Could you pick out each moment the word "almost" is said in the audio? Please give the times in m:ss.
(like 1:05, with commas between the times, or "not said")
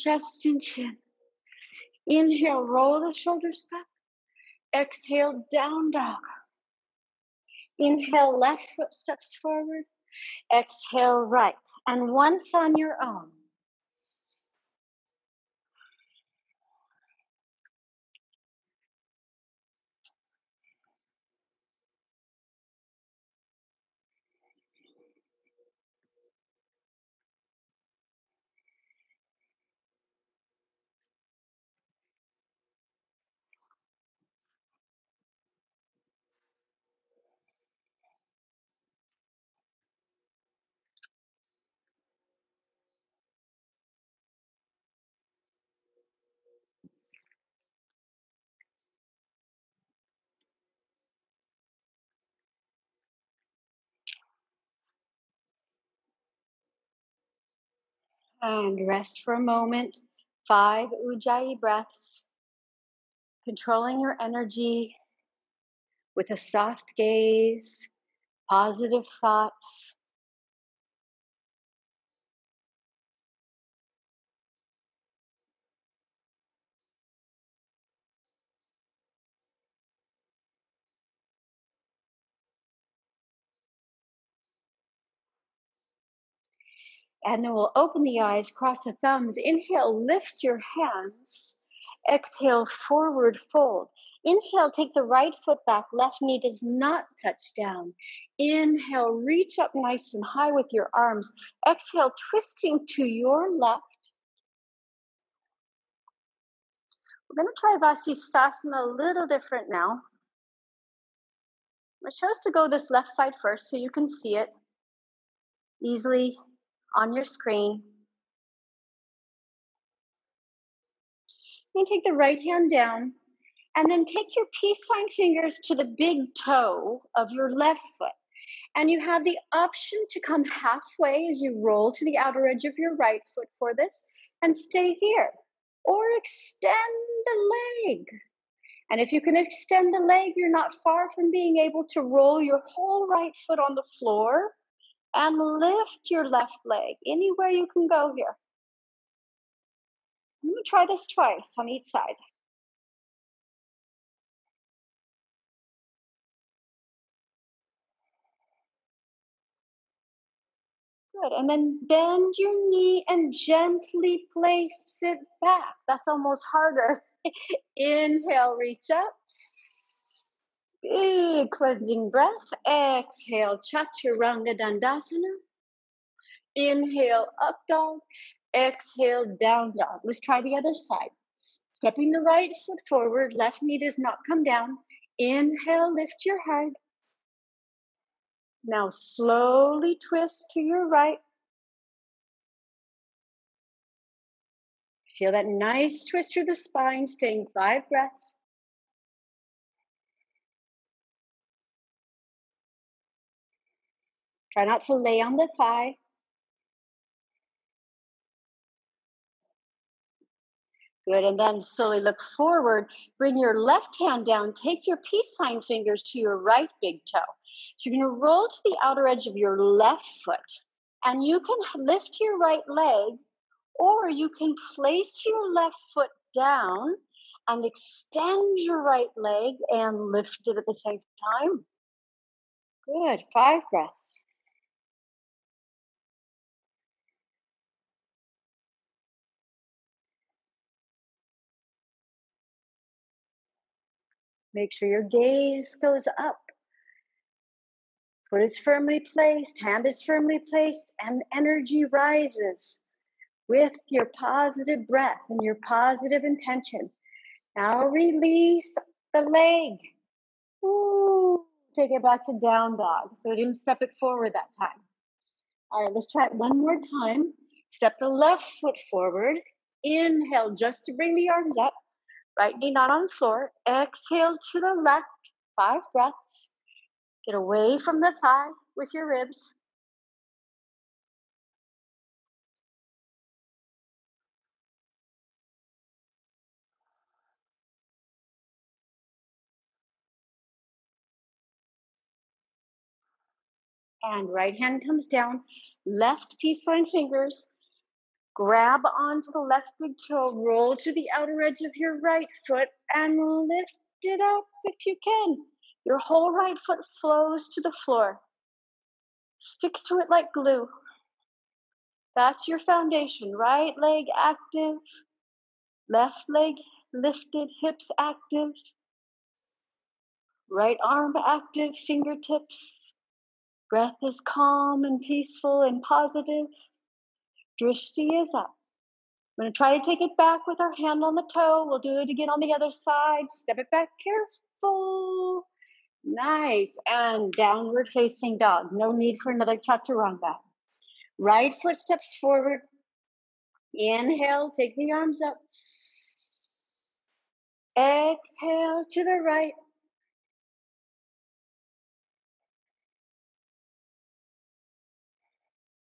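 2:46.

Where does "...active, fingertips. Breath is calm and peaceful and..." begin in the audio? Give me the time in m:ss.
5:21.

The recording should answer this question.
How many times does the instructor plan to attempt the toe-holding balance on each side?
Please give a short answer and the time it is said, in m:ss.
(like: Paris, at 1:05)
2, at 2:31.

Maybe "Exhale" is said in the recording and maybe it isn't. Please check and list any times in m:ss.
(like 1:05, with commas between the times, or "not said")
0:04, 0:10, 1:32, 1:41, 2:52, 2:58, 4:33, 5:47.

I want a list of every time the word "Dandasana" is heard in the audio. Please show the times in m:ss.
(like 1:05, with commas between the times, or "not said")
2:54.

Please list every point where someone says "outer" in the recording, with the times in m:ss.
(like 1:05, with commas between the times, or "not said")
2:12, 3:38, 5:01.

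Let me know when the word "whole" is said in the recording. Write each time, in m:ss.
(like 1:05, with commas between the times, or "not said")
2:22, 5:05.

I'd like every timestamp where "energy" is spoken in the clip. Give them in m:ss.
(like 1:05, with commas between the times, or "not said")
1:04, 4:11.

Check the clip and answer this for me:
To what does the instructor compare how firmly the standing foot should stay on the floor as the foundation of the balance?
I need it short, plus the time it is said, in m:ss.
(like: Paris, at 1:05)
Glue, at 5:10.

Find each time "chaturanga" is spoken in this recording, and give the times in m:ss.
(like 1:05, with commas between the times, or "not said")
2:53, 5:39.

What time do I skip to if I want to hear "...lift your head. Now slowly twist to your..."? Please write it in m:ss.
3:05.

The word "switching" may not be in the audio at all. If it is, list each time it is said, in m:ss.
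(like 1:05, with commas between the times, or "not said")
not said.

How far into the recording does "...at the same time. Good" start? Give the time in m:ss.
3:50.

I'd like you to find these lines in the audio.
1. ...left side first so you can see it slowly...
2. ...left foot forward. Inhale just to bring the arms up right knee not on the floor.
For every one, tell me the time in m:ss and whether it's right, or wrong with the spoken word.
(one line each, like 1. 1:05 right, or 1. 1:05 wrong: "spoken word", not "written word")
1. 1:52 wrong: "easily", not "slowly"
2. 4:28 right.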